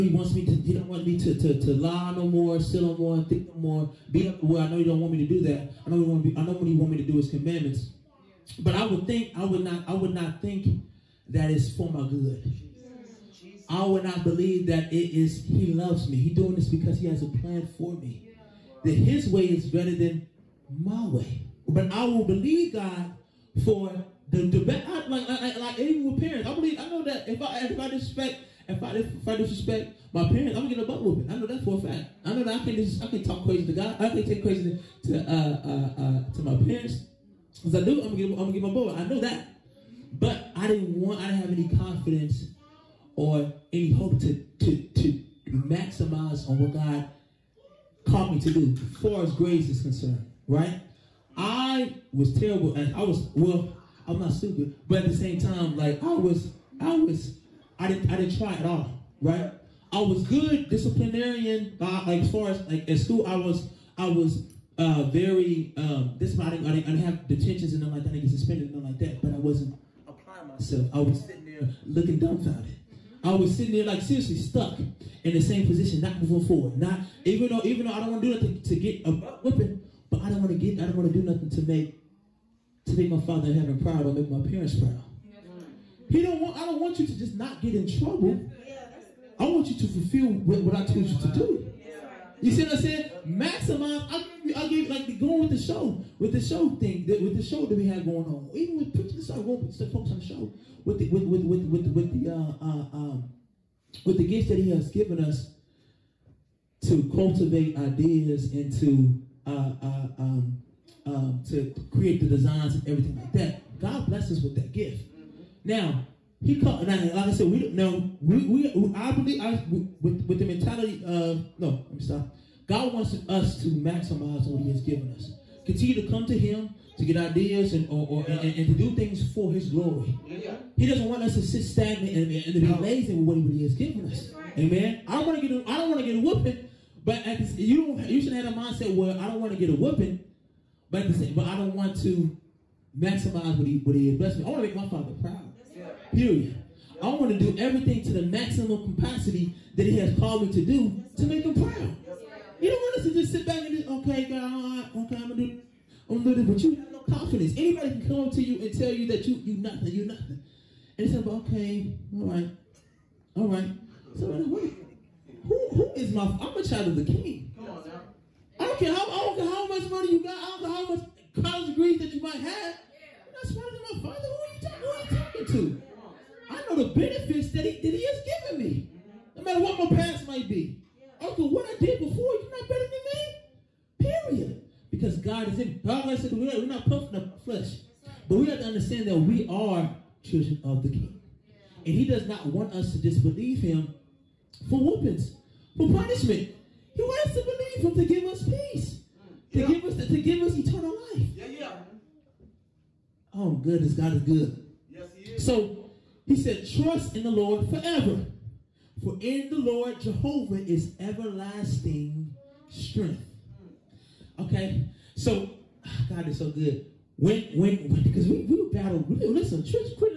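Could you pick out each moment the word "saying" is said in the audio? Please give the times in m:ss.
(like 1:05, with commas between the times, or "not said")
1:32.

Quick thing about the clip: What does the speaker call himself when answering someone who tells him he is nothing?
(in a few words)
a child of the King.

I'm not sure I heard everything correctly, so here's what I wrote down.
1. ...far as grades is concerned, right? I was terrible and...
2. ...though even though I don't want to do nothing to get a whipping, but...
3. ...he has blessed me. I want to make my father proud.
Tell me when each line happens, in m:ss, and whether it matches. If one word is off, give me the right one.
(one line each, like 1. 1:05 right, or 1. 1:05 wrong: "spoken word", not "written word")
1. 0:49 right
2. 1:17 right
3. 2:23 right.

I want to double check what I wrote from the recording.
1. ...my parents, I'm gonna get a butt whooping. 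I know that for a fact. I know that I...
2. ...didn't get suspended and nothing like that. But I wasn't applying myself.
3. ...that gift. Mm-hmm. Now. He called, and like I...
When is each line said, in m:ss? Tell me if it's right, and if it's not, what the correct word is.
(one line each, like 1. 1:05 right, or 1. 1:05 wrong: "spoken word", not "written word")
1. 0:30 right
2. 1:08 right
3. 1:54 right.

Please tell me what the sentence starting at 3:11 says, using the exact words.
And he does not want us to disbelieve him for whoopings, for punishment.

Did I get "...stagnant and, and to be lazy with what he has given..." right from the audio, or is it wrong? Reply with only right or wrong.
right.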